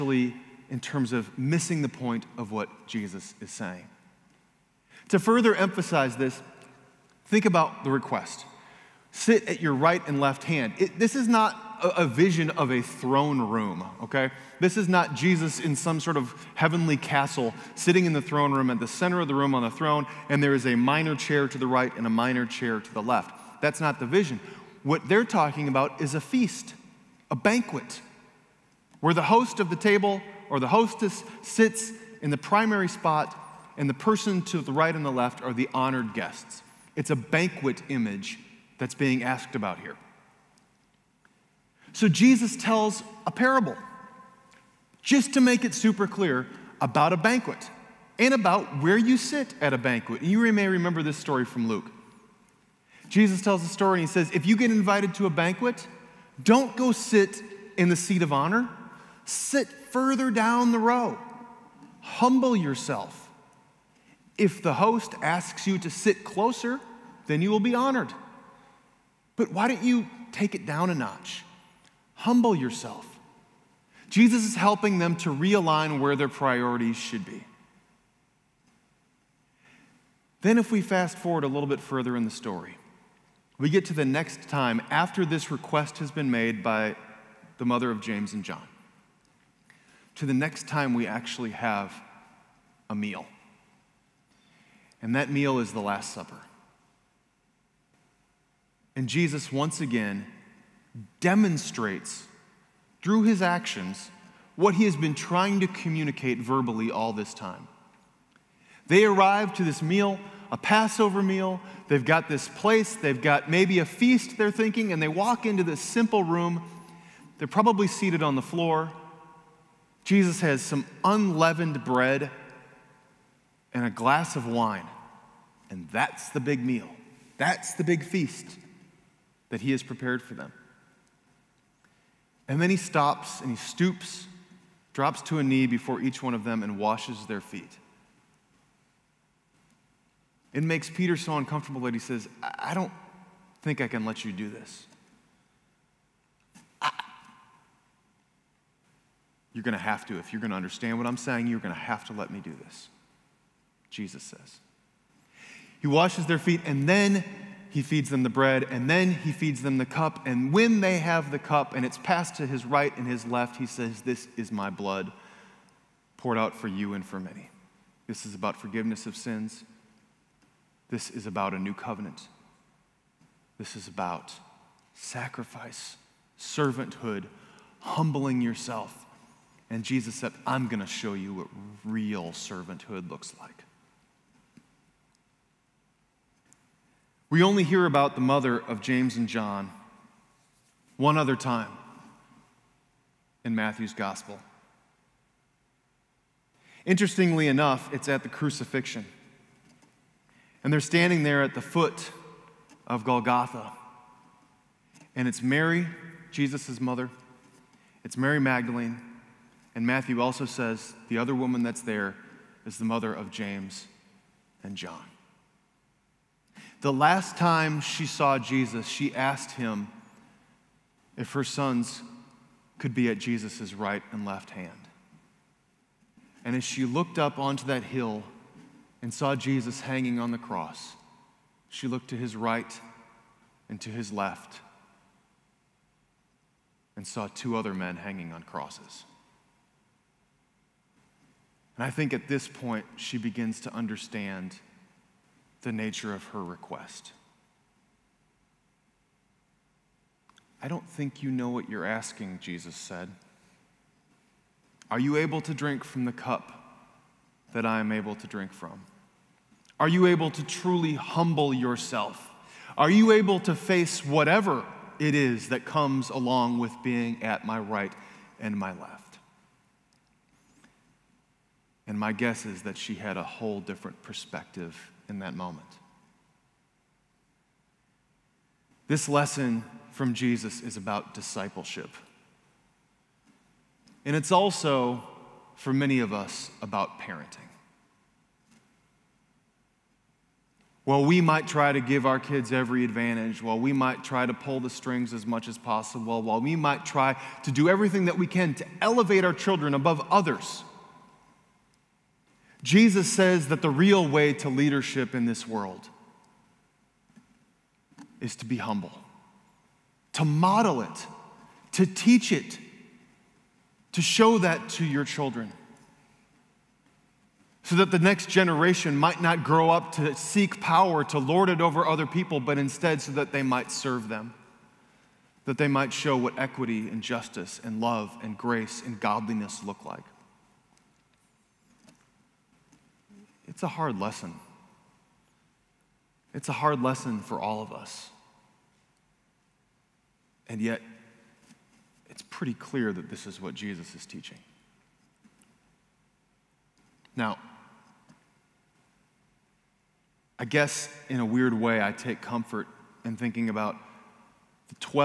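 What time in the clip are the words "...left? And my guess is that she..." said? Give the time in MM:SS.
04:28.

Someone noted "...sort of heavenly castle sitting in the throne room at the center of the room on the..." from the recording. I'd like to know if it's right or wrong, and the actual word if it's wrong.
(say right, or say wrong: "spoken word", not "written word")
right.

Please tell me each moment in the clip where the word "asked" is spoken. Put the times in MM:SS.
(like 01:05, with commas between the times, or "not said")
00:39, 03:39.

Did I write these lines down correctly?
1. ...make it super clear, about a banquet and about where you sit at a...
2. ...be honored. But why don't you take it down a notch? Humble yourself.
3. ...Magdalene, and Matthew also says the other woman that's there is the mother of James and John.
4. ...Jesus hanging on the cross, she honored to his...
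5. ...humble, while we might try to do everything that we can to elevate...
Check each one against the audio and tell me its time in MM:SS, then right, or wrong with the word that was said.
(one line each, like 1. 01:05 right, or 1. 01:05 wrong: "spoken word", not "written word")
1. 00:45 right
2. 01:07 right
3. 03:28 right
4. 03:49 wrong: "looked", not "honored"
5. 04:55 wrong: "possible", not "humble".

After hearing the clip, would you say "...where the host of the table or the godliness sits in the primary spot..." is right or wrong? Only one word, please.
wrong.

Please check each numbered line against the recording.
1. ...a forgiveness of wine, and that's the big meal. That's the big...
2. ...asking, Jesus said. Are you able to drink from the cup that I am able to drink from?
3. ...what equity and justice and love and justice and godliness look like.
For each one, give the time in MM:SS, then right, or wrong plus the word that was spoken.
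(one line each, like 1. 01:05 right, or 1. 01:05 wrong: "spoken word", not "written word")
1. 02:03 wrong: "glass", not "forgiveness"
2. 04:11 right
3. 05:26 wrong: "grace", not "justice".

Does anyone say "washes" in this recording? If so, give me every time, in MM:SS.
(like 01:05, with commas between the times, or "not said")
02:16, 02:35.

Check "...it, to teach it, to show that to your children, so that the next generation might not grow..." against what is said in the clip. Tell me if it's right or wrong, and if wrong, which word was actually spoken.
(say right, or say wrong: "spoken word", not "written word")
right.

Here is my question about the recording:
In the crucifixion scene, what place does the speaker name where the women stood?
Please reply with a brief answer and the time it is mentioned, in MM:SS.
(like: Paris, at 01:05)
Golgotha, at 03:23.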